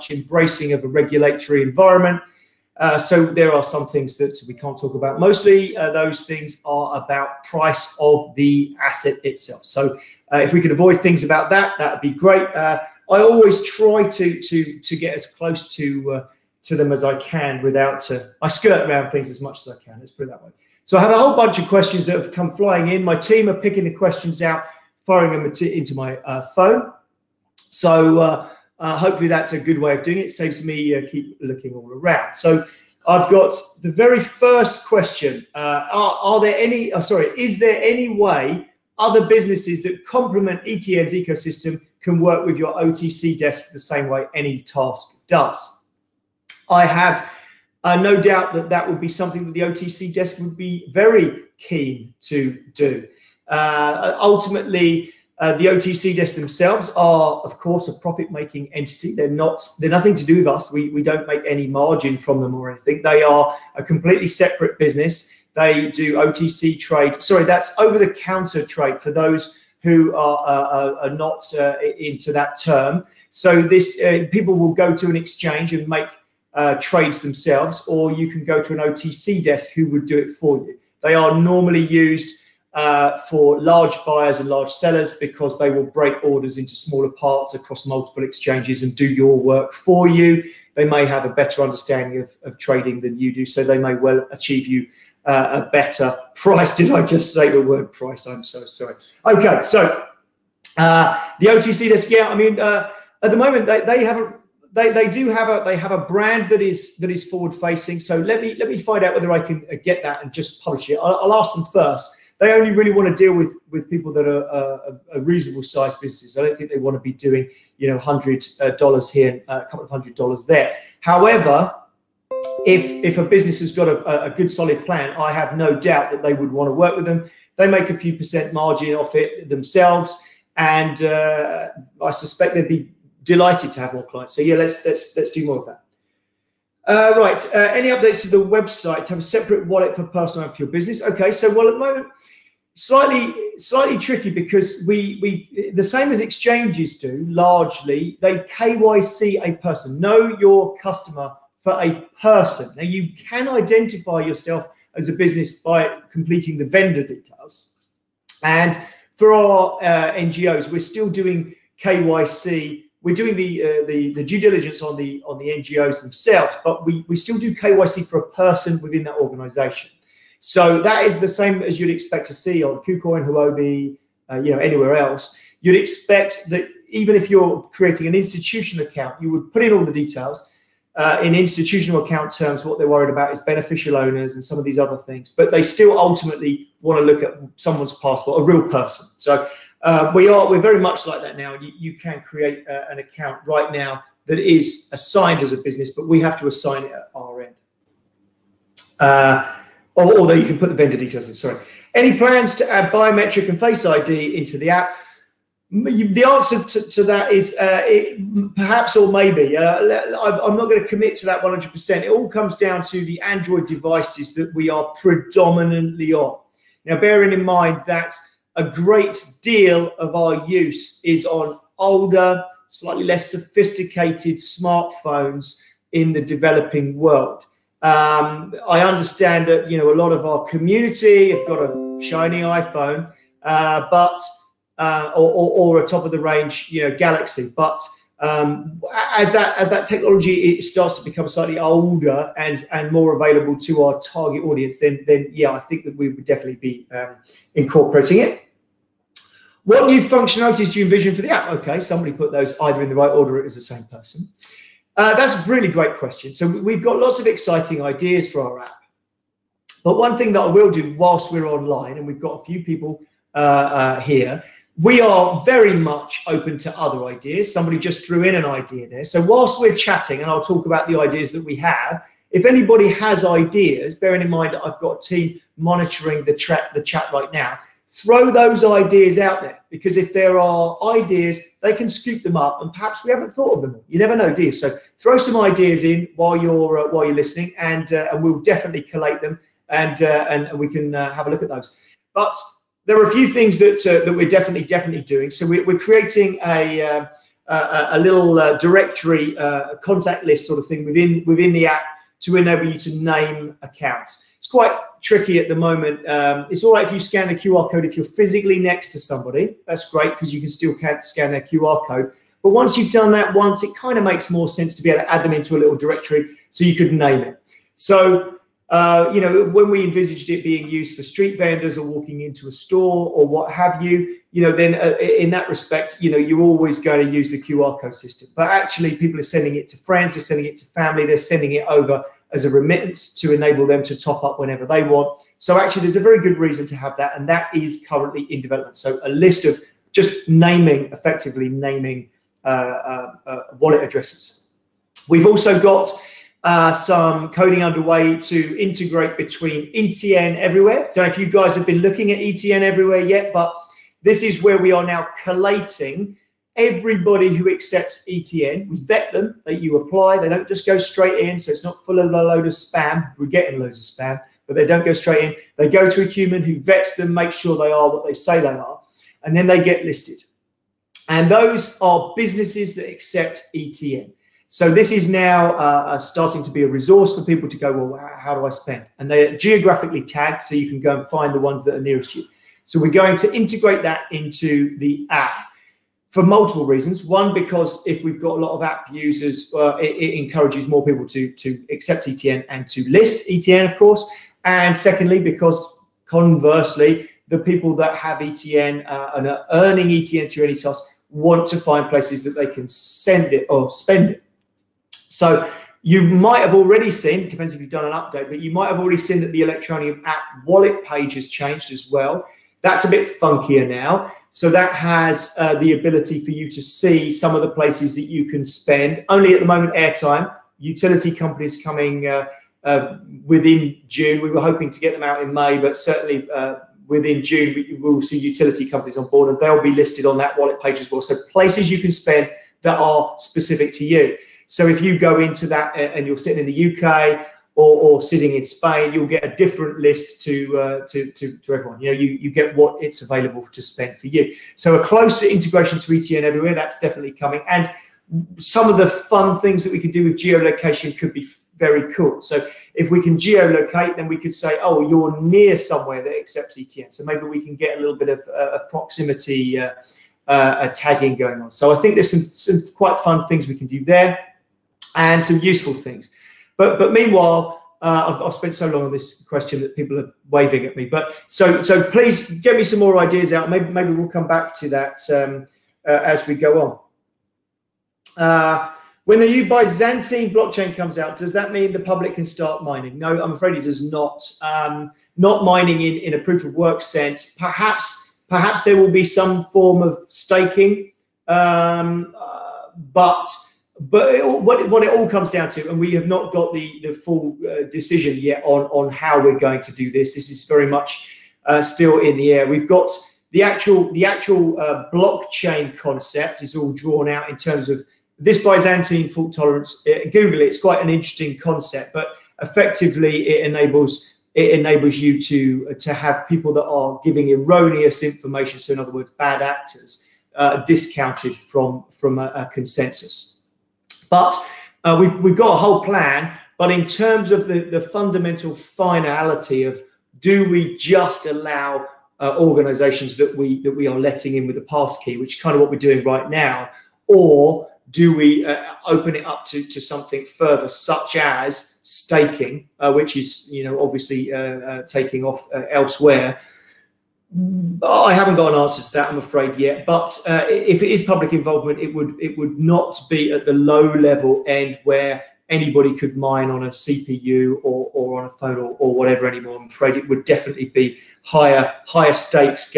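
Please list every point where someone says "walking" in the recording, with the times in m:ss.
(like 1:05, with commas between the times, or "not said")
5:21.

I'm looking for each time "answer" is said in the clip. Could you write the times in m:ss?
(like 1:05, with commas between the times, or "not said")
3:26, 9:08.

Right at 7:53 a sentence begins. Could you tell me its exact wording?
Maybe maybe we'll come back to that um, uh, as we go on.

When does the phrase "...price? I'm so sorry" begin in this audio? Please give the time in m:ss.
1:37.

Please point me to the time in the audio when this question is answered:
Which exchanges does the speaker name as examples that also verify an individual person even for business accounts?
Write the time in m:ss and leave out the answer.
2:52.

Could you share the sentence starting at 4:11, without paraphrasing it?
Okay, somebody put those either in the right order.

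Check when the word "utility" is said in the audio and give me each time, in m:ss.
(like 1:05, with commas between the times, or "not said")
7:00, 7:08.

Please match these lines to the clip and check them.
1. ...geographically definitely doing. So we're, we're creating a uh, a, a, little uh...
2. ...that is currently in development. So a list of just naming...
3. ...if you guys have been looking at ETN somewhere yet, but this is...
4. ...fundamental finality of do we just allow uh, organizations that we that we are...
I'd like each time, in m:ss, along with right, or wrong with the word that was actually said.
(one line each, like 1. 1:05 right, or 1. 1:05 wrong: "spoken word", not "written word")
1. 4:54 wrong: "definitely", not "geographically"
2. 5:37 right
3. 5:51 wrong: "everywhere", not "somewhere"
4. 8:47 right.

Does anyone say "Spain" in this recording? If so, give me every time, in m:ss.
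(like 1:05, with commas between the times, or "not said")
7:18.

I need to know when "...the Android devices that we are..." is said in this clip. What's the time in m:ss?
3:33.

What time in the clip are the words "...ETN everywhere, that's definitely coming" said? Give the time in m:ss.
7:25.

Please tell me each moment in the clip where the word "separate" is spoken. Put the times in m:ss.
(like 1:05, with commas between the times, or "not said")
1:04, 2:19.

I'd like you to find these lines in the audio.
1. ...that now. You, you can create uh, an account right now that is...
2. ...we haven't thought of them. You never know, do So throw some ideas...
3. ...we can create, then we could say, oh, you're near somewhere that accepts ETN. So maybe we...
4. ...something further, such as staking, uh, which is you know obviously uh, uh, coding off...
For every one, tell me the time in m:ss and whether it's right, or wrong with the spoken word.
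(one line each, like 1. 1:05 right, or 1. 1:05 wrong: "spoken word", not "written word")
1. 3:11 right
2. 4:43 right
3. 7:32 wrong: "geolocate", not "create"
4. 8:59 wrong: "taking", not "coding".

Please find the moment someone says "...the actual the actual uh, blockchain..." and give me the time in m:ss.
8:23.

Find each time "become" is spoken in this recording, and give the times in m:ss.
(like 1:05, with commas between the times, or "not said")
4:01.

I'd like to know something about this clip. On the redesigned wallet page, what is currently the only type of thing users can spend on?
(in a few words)
Airtime.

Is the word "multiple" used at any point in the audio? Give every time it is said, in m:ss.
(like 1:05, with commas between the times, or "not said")
1:27, 6:26.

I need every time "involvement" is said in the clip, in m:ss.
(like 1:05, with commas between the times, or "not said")
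9:11.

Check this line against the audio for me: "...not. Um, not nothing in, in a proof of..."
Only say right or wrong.
wrong.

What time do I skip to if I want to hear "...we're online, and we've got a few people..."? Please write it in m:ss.
4:21.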